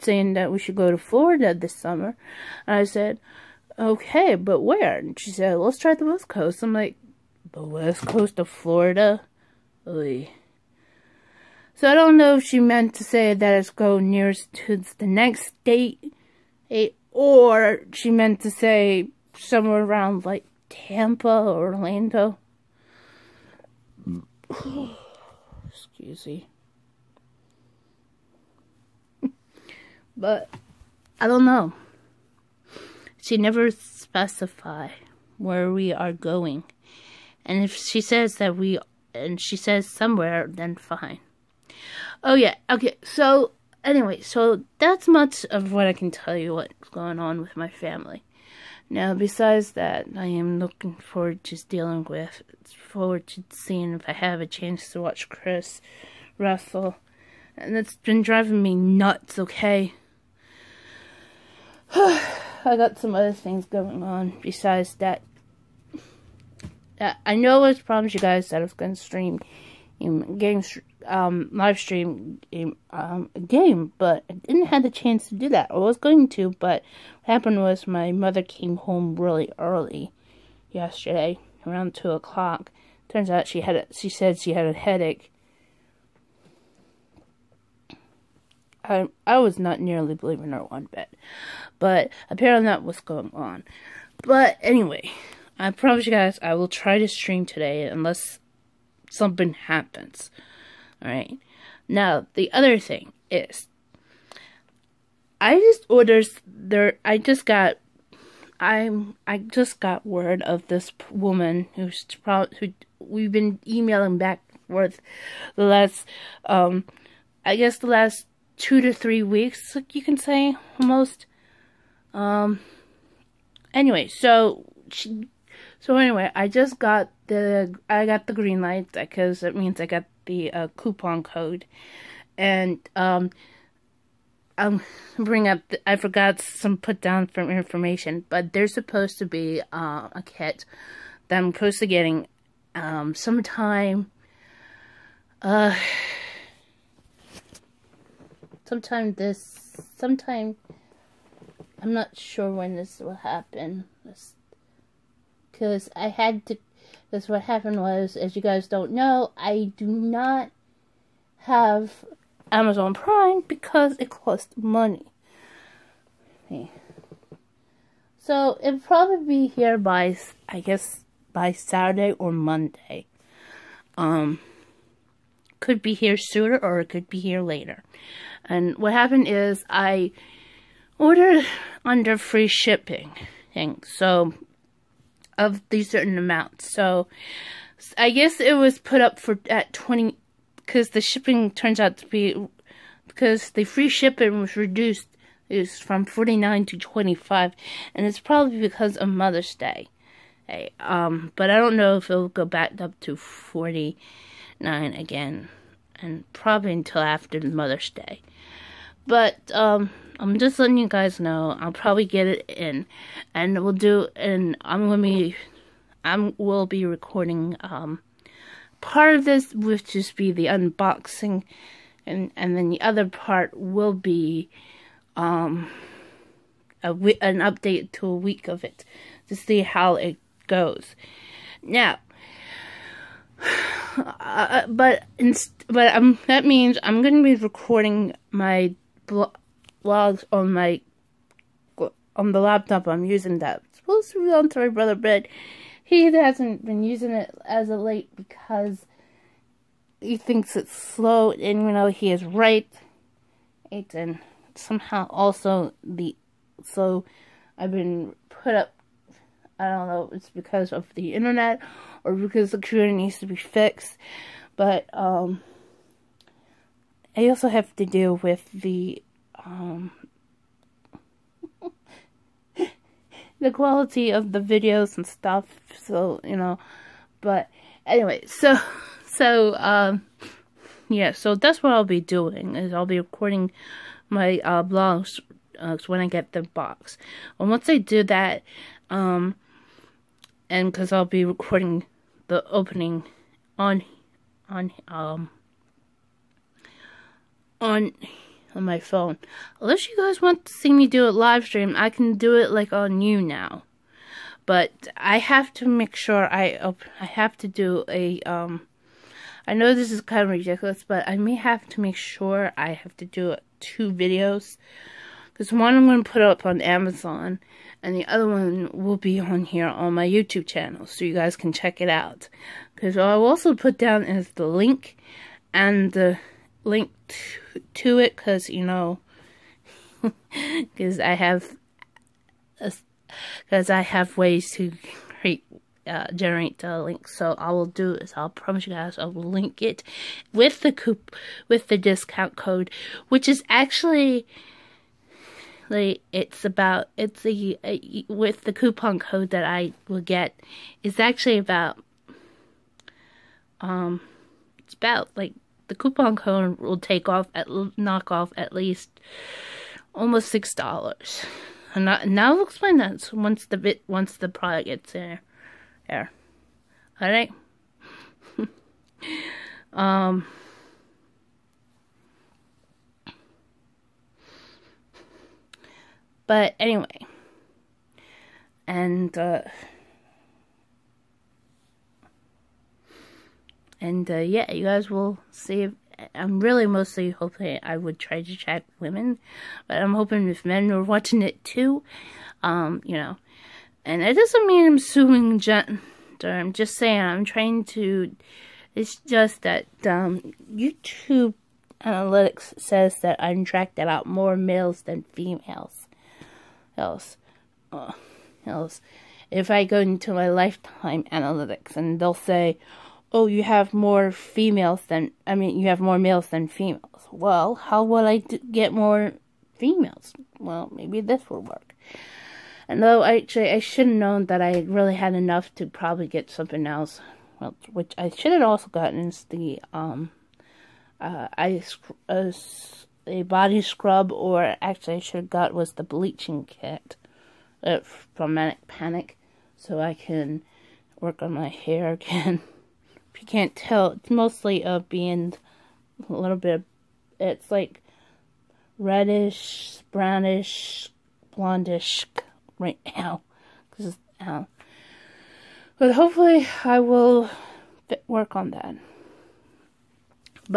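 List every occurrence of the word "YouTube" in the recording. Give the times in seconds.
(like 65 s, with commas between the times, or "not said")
320 s, 400 s.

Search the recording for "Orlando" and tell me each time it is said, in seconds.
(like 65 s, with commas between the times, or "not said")
21 s.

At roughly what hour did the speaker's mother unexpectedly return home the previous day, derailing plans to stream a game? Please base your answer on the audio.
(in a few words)
2 o'clock.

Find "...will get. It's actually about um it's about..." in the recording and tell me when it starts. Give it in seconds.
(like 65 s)
349 s.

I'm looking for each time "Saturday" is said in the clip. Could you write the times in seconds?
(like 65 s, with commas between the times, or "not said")
171 s.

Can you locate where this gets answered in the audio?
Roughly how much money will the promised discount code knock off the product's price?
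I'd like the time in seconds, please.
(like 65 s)
360 s.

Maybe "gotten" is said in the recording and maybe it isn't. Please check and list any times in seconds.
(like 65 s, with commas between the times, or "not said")
428 s.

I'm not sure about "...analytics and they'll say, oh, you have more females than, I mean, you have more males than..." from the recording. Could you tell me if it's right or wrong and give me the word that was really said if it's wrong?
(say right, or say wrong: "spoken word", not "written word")
right.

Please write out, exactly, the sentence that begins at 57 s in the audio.
And it's been driving me nuts, okay?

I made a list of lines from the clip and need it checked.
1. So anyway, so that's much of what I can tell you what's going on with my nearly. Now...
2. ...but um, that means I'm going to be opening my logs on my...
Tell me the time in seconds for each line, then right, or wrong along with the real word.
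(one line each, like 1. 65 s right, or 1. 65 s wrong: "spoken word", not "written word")
1. 43 s wrong: "family", not "nearly"
2. 235 s wrong: "recording", not "opening".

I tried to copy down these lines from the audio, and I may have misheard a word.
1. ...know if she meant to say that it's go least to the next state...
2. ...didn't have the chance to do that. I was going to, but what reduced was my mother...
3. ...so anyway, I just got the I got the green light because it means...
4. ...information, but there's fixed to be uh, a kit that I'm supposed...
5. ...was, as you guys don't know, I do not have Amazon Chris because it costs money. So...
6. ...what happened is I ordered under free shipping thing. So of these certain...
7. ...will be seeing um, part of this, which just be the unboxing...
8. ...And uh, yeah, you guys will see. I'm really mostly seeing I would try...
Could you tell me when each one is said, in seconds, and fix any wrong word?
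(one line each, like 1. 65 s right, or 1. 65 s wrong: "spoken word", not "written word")
1. 12 s wrong: "nearest", not "least"
2. 74 s wrong: "happened", not "reduced"
3. 125 s right
4. 137 s wrong: "supposed", not "fixed"
5. 157 s wrong: "Prime", not "Chris"
6. 178 s right
7. 216 s wrong: "recording", not "seeing"
8. 383 s wrong: "hoping", not "seeing".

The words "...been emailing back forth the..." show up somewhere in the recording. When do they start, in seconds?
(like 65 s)
113 s.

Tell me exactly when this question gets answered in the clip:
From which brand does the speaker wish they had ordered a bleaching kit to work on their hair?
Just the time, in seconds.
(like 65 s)
438 s.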